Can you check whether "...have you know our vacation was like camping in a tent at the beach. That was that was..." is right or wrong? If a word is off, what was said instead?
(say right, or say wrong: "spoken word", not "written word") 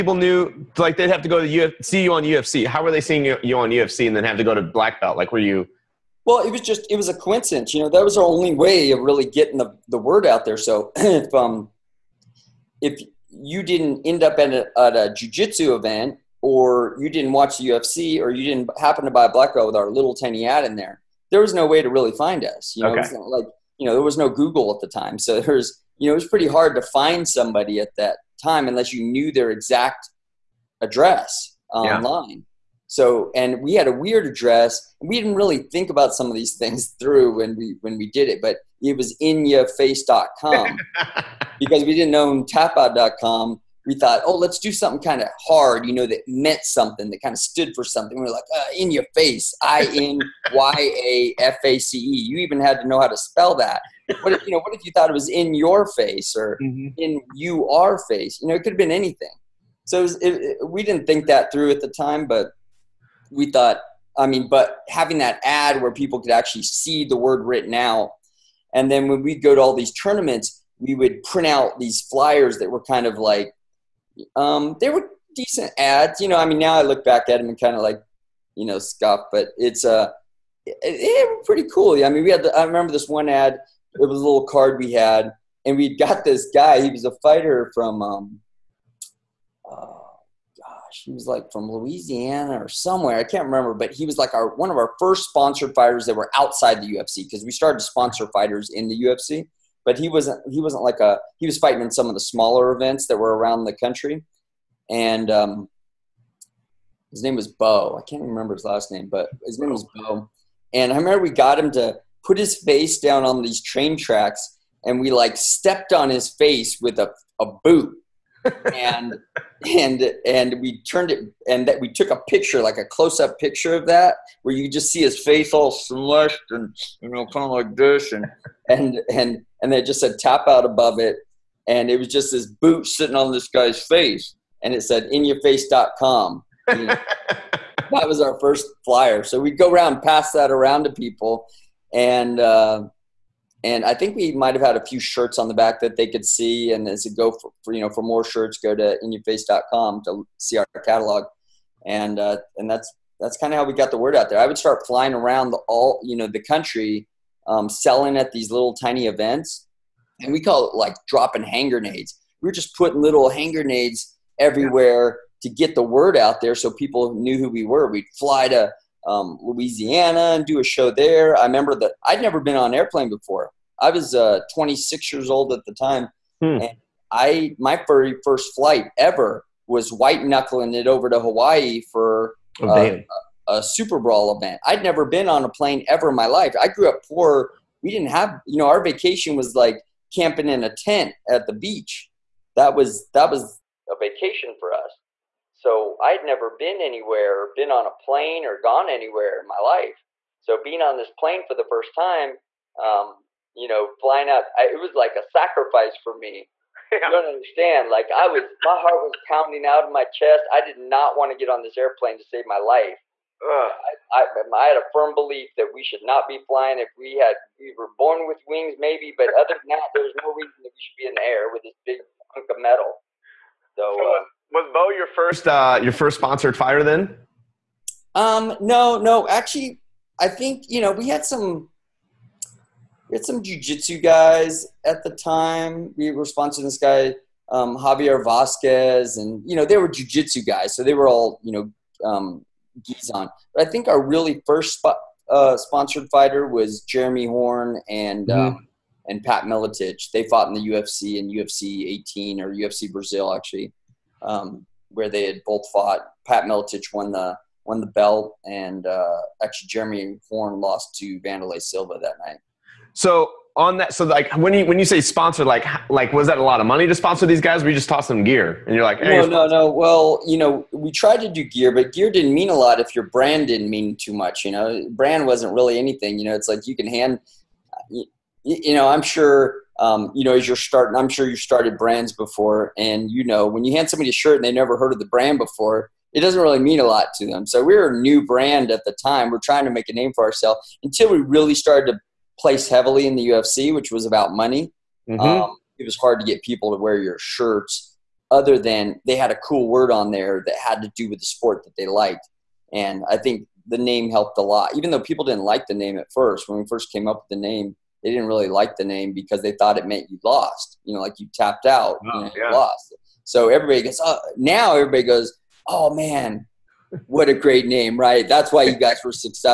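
right.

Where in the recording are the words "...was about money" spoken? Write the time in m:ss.
4:53.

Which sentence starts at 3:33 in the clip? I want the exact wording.
I, I, I, had a firm belief that we should not be flying.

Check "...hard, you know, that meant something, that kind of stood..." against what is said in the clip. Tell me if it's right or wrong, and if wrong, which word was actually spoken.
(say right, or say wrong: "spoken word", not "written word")
right.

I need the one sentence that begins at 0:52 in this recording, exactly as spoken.
You even had to know how to spell that.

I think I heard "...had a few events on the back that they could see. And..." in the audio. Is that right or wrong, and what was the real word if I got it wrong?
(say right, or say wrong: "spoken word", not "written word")
wrong: "shirts", not "events".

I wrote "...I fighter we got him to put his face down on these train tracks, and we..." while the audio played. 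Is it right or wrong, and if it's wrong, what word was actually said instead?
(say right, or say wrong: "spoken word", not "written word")
wrong: "remember", not "fighter".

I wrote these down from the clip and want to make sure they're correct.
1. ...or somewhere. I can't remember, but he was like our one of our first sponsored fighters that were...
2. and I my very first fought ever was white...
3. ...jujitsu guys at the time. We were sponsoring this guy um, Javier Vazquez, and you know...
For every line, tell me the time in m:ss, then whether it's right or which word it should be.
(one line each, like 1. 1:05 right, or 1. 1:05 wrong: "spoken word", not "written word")
1. 1:32 right
2. 2:56 wrong: "flight", not "fought"
3. 3:53 right.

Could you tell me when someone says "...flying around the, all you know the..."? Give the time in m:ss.
2:34.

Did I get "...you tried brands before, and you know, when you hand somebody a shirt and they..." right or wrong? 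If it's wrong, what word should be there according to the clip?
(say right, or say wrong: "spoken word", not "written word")
wrong: "started", not "tried".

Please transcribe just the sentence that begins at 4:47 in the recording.
So we were a new brand at the time.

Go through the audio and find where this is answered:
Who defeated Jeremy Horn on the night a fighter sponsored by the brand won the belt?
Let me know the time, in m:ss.
4:21.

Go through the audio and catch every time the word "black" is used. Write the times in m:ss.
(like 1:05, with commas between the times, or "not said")
0:04, 0:19.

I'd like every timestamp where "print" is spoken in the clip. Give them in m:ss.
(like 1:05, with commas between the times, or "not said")
1:11.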